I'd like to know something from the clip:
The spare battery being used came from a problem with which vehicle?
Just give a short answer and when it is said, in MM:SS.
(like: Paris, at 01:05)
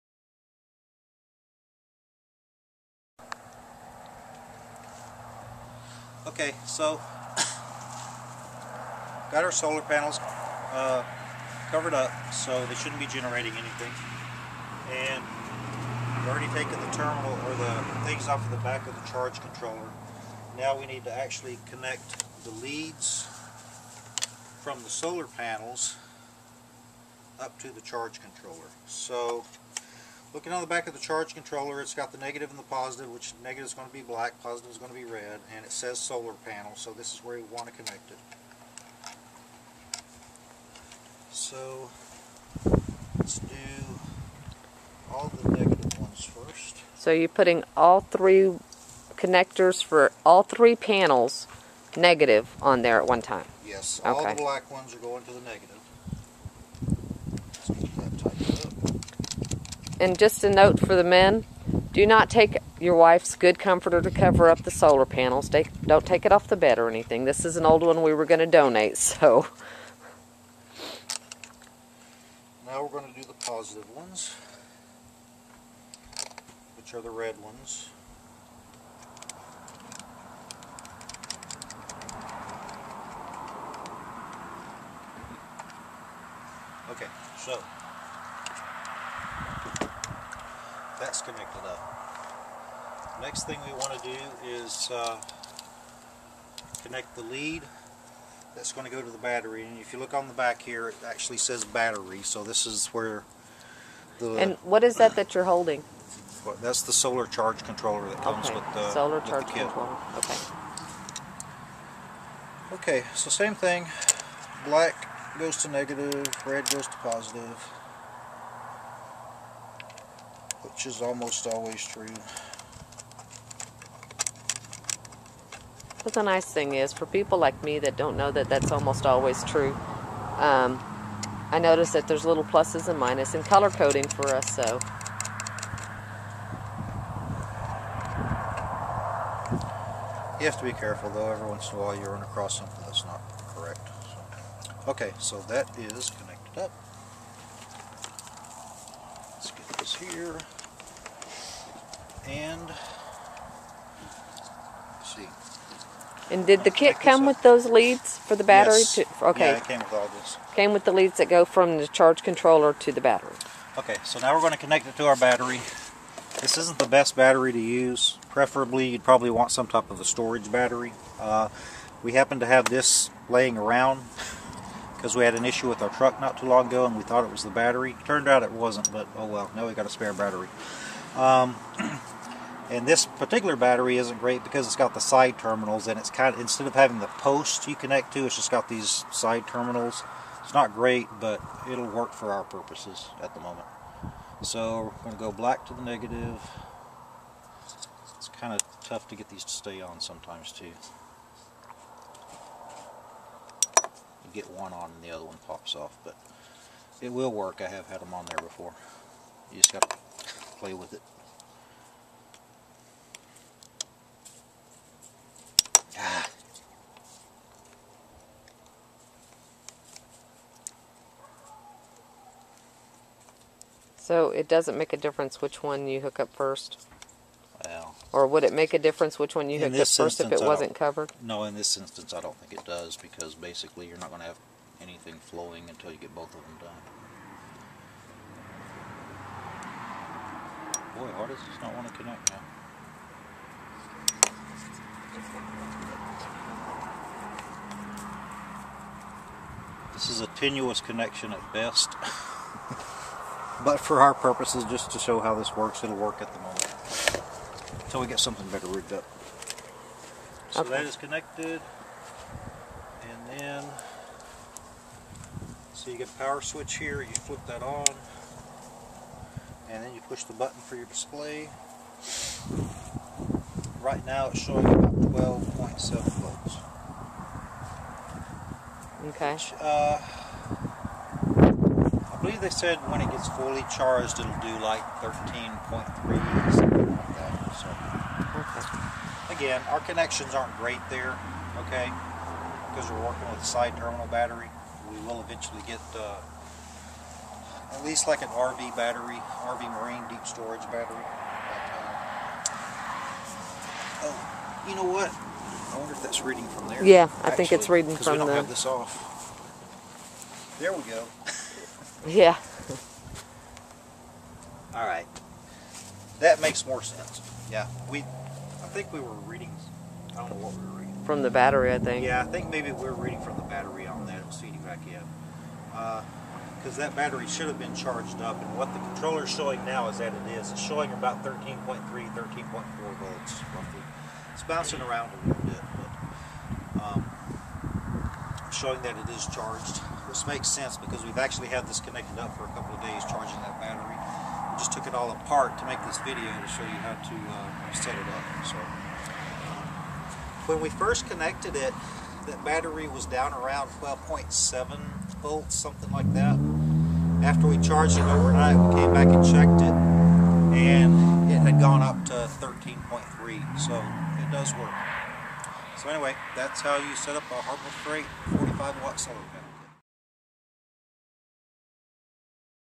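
Truck, at 02:55.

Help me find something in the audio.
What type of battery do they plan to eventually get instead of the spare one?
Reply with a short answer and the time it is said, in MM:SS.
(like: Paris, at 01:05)
RV Marine deep storage battery, at 04:59.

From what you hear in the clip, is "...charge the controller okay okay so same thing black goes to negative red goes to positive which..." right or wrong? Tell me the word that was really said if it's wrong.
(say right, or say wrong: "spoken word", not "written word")
right.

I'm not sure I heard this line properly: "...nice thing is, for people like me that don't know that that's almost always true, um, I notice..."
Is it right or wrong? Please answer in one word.
right.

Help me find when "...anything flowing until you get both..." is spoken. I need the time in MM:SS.
03:54.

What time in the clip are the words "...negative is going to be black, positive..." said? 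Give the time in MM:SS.
00:33.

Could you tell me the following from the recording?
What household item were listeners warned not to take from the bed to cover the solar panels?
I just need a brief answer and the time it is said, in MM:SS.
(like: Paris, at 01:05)
Wife's good comforter, at 01:02.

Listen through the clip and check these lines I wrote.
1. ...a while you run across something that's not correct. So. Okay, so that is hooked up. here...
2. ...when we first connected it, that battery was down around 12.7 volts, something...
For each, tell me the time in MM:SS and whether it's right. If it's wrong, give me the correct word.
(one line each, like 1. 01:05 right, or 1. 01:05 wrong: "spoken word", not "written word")
1. 02:21 wrong: "connected", not "hooked"
2. 05:50 right.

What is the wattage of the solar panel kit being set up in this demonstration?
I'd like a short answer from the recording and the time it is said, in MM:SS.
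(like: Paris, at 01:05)
45 watt, at 06:08.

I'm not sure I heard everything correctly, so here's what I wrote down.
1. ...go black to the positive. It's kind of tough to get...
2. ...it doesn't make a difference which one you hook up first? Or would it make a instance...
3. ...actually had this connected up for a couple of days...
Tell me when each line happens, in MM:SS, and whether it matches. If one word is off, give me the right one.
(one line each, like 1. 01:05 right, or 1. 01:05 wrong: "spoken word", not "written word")
1. 03:15 wrong: "negative", not "positive"
2. 03:44 wrong: "difference", not "instance"
3. 05:41 right.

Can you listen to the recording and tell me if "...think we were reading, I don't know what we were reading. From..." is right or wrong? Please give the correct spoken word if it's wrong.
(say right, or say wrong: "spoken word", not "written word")
right.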